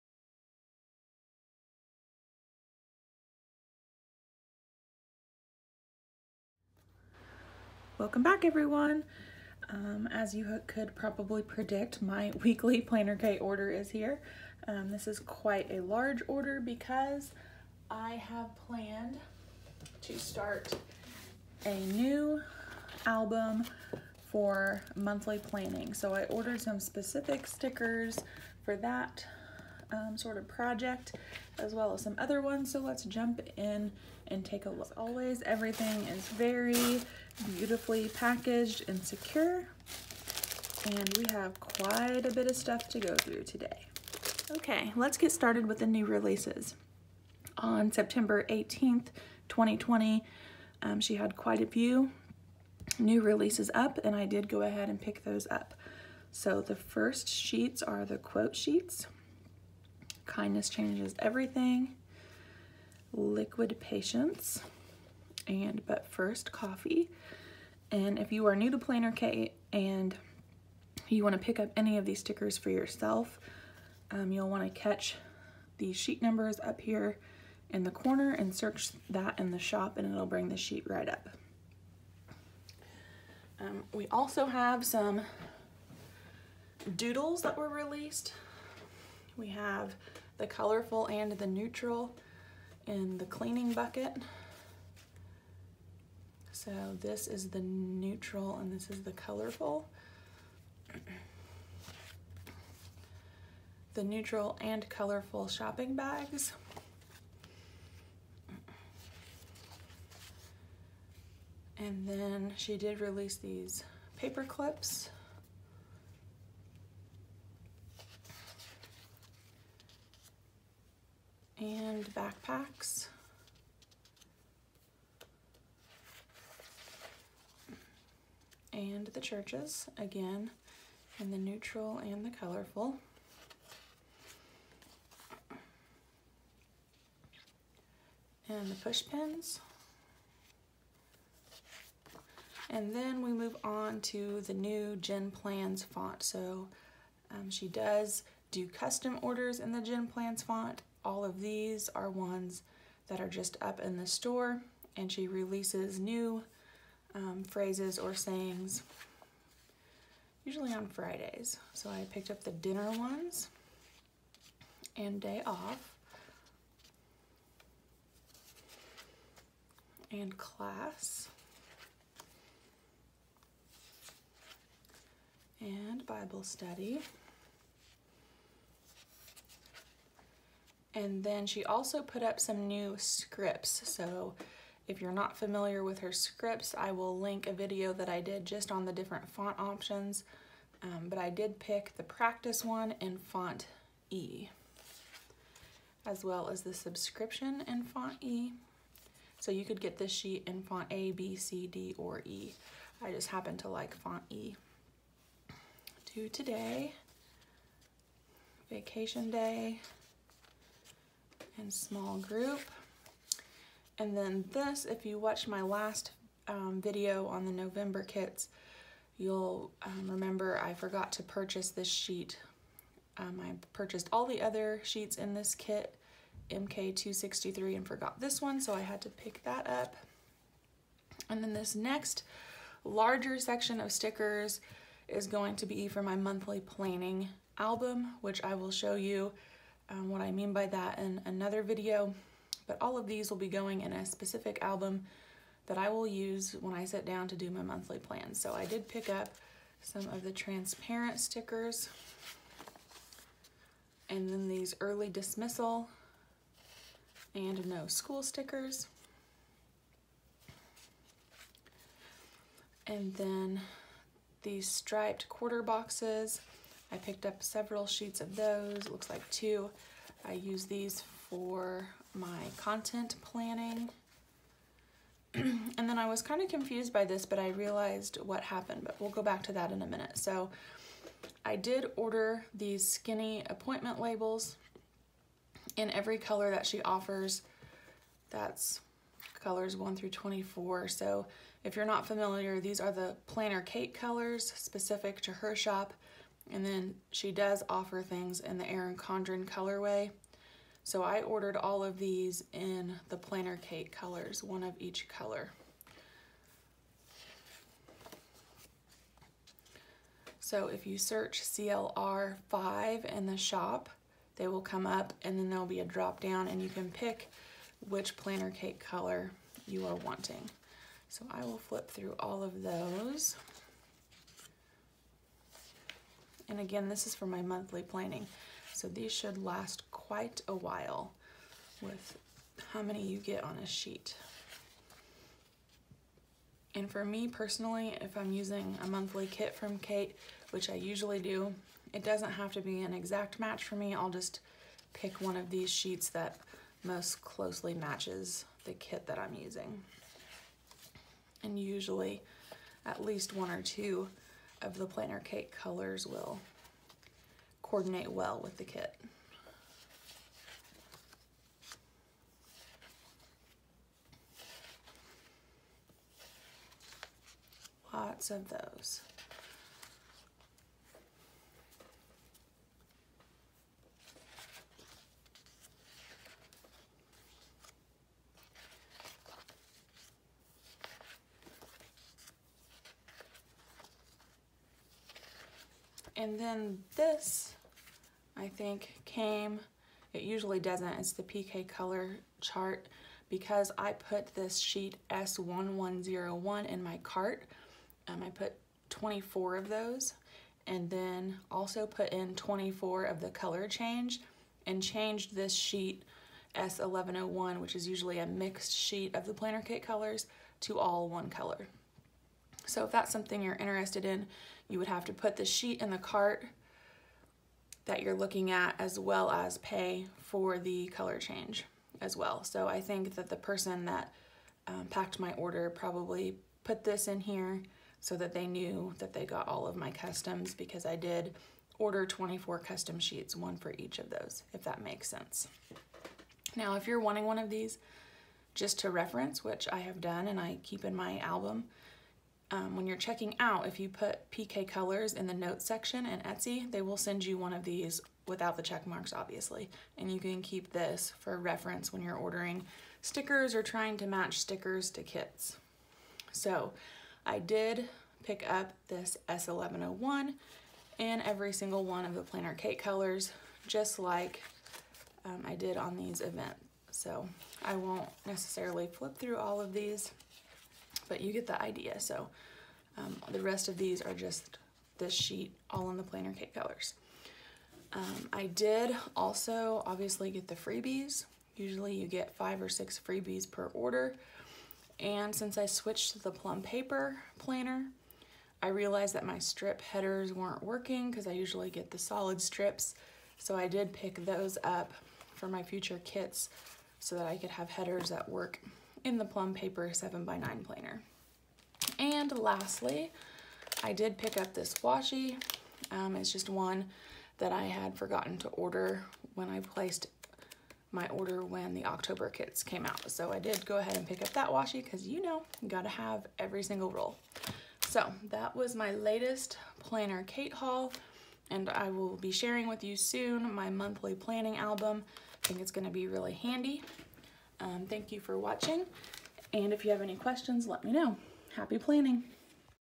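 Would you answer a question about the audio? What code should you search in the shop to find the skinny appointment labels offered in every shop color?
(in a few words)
CLR5.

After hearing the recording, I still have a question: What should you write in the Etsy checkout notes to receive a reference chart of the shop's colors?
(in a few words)
PK colors.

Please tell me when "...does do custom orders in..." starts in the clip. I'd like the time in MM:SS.
02:27.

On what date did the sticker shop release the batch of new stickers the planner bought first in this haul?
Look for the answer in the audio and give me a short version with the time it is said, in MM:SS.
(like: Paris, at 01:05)
September 18th, 2020, at 00:47.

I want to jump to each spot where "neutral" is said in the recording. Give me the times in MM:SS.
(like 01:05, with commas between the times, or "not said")
01:31, 01:37, 01:44, 02:11.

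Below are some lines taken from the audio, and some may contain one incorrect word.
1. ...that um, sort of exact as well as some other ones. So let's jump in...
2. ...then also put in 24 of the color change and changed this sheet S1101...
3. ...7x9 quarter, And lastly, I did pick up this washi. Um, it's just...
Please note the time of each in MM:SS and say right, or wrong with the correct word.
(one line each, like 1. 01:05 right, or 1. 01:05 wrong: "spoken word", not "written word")
1. 00:28 wrong: "project", not "exact"
2. 06:40 right
3. 08:19 wrong: "planner", not "quarter".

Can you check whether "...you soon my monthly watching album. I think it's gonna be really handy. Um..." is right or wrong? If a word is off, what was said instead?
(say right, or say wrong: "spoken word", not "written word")
wrong: "planning", not "watching".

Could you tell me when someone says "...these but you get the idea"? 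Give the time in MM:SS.
07:49.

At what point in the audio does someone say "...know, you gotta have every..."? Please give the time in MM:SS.
08:35.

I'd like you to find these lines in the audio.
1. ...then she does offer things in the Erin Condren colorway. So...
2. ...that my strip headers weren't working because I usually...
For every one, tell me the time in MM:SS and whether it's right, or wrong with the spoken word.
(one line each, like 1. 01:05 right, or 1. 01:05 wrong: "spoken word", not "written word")
1. 04:56 right
2. 08:09 right.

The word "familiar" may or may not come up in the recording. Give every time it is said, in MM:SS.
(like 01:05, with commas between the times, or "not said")
03:05, 04:52.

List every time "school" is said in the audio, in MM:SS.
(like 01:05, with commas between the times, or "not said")
04:17.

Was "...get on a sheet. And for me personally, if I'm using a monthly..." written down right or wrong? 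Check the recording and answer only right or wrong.
right.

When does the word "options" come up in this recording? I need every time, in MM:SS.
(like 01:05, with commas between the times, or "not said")
03:09.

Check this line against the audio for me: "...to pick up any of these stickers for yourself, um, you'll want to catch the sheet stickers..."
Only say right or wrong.
wrong.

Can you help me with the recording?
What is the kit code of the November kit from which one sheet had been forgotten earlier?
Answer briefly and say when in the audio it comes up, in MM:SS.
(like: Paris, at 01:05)
MK263, at 03:46.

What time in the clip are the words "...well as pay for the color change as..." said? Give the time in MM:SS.
06:58.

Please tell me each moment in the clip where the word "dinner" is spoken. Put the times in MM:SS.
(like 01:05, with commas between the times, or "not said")
02:42.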